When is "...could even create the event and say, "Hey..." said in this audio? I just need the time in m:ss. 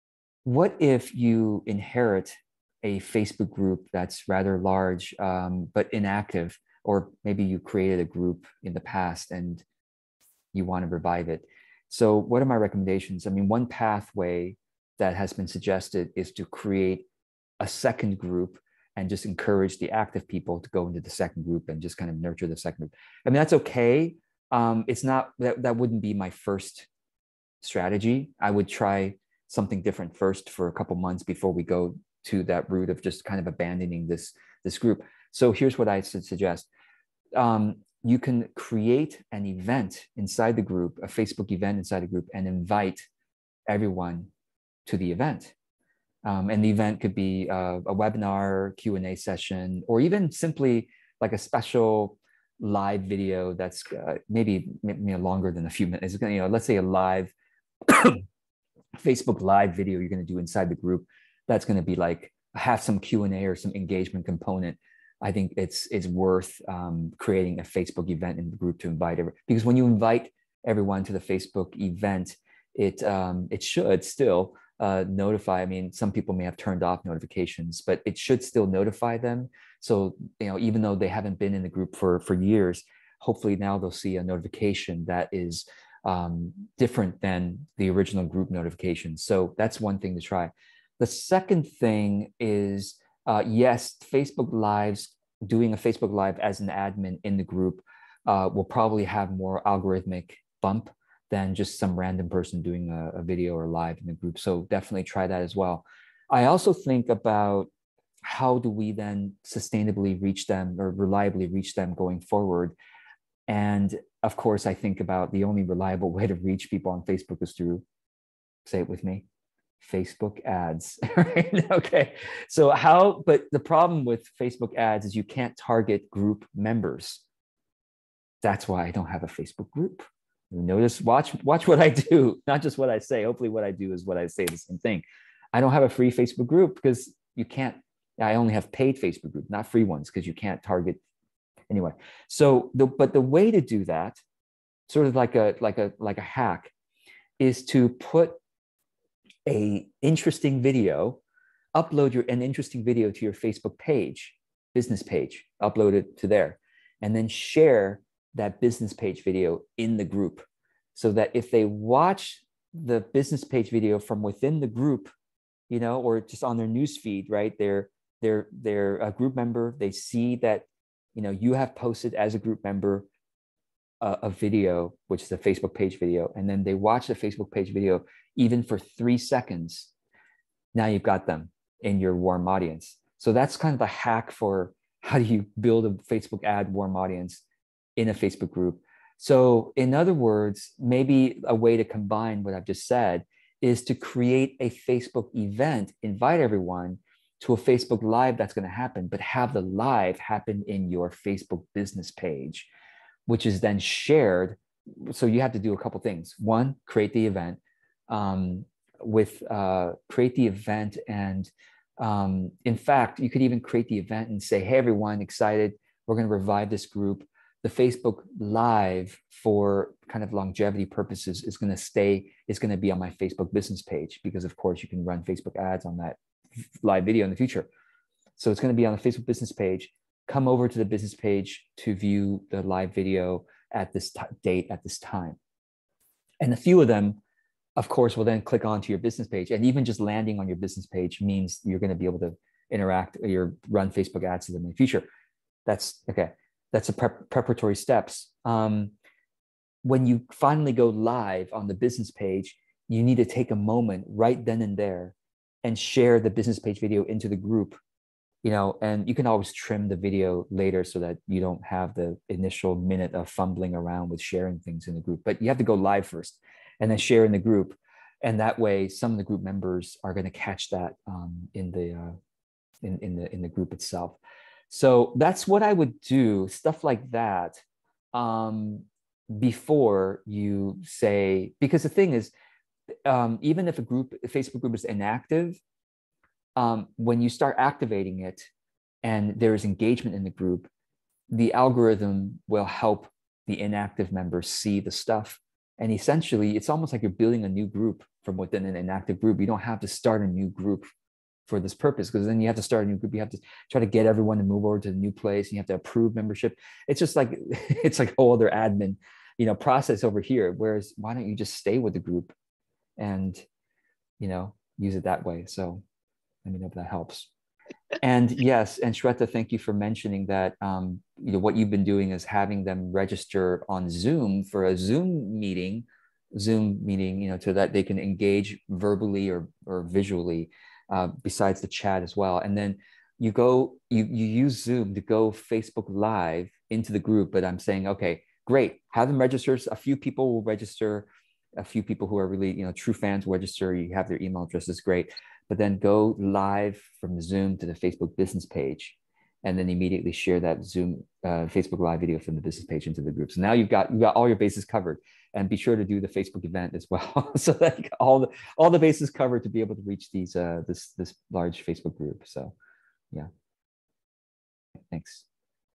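3:33.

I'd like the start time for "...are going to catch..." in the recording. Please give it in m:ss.
4:30.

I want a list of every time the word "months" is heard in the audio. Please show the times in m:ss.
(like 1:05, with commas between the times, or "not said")
0:30.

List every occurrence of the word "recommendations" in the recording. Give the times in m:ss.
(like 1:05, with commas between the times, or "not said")
0:12.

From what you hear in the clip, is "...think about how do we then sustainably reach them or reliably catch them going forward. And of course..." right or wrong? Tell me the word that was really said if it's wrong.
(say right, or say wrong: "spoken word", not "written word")
wrong: "reach", not "catch".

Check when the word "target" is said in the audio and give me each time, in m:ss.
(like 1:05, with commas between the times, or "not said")
2:05, 2:20.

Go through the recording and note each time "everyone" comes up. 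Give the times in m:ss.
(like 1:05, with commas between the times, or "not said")
0:43, 1:10, 3:16, 3:34, 5:04.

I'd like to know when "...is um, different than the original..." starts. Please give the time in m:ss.
1:25.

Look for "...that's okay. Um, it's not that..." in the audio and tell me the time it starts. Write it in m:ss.
0:23.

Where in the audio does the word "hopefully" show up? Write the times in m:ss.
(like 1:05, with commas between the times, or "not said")
1:23, 2:13.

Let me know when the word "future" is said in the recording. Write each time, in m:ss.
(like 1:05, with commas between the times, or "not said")
3:47, 4:04.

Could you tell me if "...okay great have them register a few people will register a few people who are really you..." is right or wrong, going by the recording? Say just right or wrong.
right.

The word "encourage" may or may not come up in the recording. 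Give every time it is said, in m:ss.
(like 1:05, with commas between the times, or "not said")
0:19.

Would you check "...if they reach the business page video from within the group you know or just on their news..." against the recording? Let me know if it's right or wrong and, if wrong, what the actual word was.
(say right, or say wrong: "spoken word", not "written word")
wrong: "watch", not "reach".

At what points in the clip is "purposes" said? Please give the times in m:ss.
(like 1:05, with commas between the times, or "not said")
3:40, 5:01.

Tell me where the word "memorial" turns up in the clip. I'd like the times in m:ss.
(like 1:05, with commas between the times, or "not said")
not said.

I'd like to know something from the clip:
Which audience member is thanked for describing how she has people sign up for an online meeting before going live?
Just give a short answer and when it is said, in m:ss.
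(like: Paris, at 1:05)
Shweta, at 5:18.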